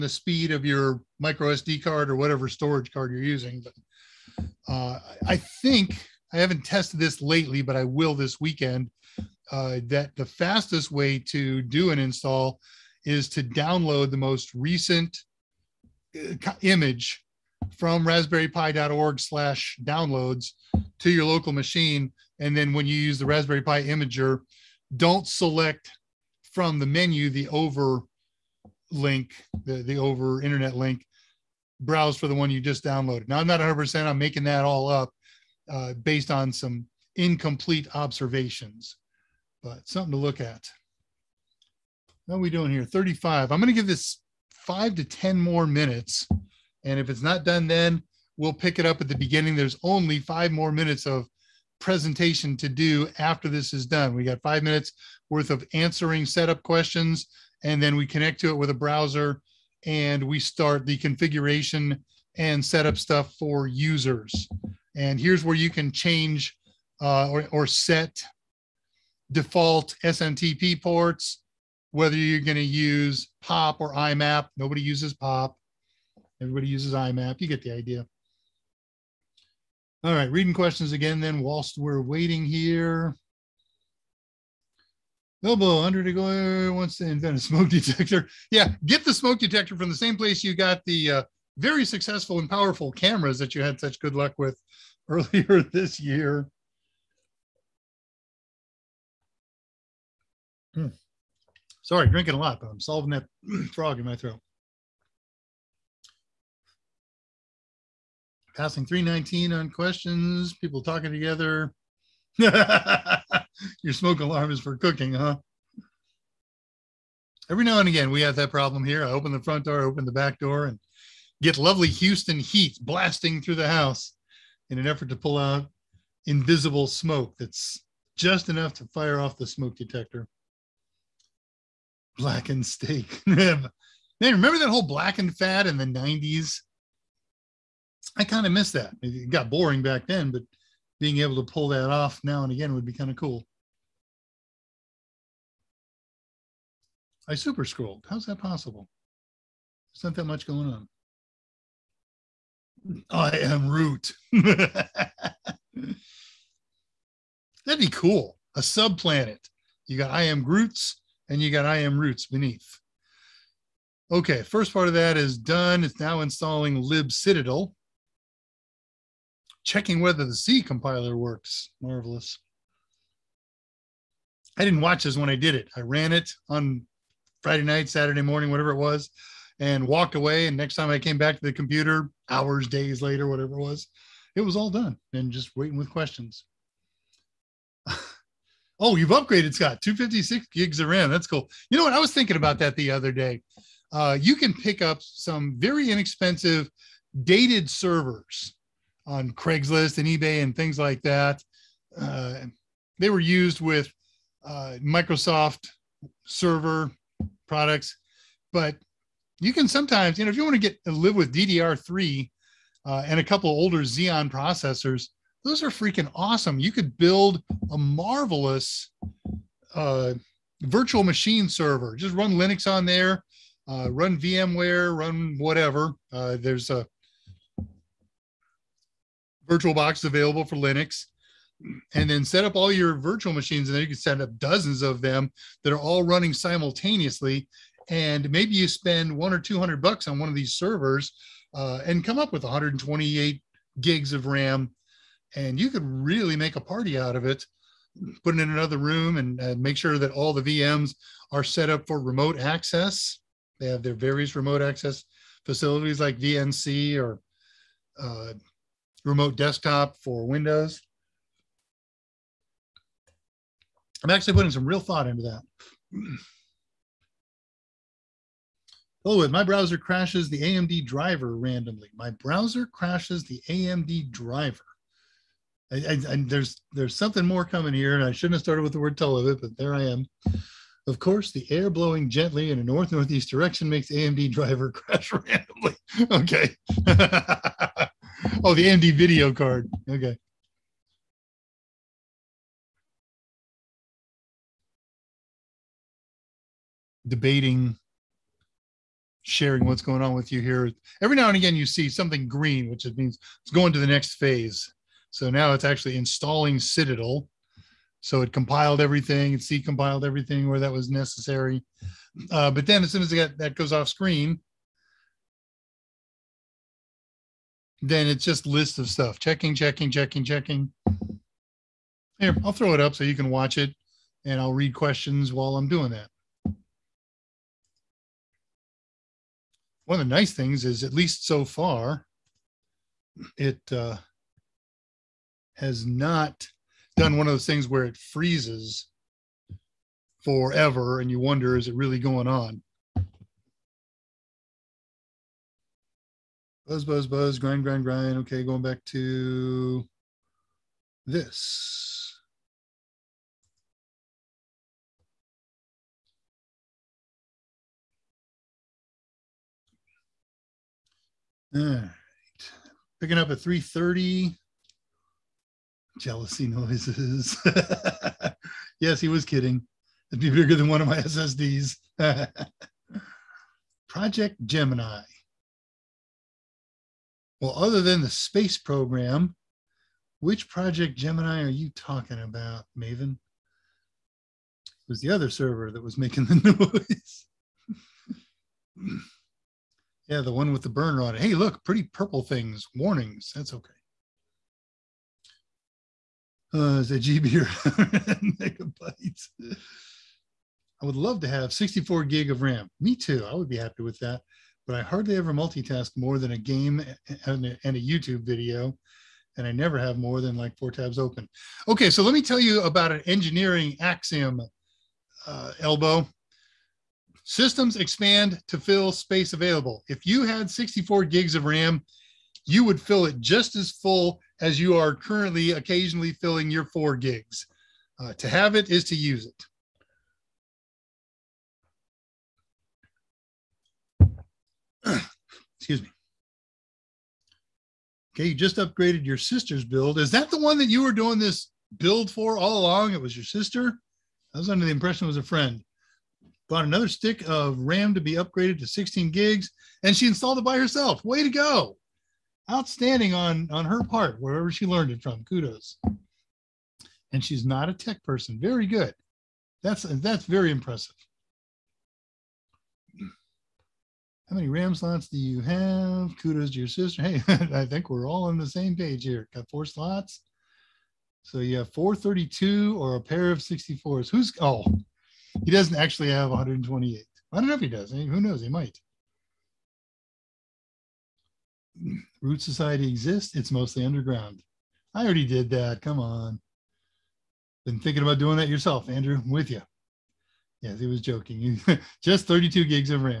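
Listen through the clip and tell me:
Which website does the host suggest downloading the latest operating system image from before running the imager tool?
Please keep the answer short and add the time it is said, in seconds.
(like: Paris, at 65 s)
raspberrypi.org, at 18 s.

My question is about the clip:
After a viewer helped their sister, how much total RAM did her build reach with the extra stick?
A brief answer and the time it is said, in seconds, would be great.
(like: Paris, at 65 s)
16 GB, at 448 s.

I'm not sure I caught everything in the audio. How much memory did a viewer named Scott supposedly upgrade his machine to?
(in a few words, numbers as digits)
256 GB.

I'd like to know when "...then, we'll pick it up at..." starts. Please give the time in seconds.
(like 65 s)
47 s.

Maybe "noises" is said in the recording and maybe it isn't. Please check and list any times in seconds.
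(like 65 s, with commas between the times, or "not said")
366 s, 387 s.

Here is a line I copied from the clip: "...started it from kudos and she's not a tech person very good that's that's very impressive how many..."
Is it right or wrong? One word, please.
wrong.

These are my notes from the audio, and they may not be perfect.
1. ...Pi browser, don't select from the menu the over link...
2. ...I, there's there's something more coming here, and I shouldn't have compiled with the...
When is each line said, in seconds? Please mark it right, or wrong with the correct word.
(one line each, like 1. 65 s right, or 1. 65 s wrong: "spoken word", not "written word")
1. 23 s wrong: "imager", not "browser"
2. 276 s wrong: "started", not "compiled".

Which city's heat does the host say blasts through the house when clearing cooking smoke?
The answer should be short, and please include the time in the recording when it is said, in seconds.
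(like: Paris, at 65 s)
Houston, at 121 s.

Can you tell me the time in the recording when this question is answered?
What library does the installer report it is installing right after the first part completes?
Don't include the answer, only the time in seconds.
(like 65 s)
166 s.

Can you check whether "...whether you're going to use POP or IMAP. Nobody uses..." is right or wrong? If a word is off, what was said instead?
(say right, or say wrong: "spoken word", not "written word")
right.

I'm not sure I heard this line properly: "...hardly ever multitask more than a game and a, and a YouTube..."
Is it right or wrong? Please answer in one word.
right.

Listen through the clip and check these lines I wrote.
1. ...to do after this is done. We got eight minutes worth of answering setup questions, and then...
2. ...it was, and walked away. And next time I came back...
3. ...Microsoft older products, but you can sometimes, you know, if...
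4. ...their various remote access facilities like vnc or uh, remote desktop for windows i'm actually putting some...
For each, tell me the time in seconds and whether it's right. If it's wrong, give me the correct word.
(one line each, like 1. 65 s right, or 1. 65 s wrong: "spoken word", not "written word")
1. 52 s wrong: "five", not "eight"
2. 178 s right
3. 204 s wrong: "server", not "older"
4. 253 s right.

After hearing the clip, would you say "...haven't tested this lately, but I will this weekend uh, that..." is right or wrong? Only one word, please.
right.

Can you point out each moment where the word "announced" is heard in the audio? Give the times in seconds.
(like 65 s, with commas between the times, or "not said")
not said.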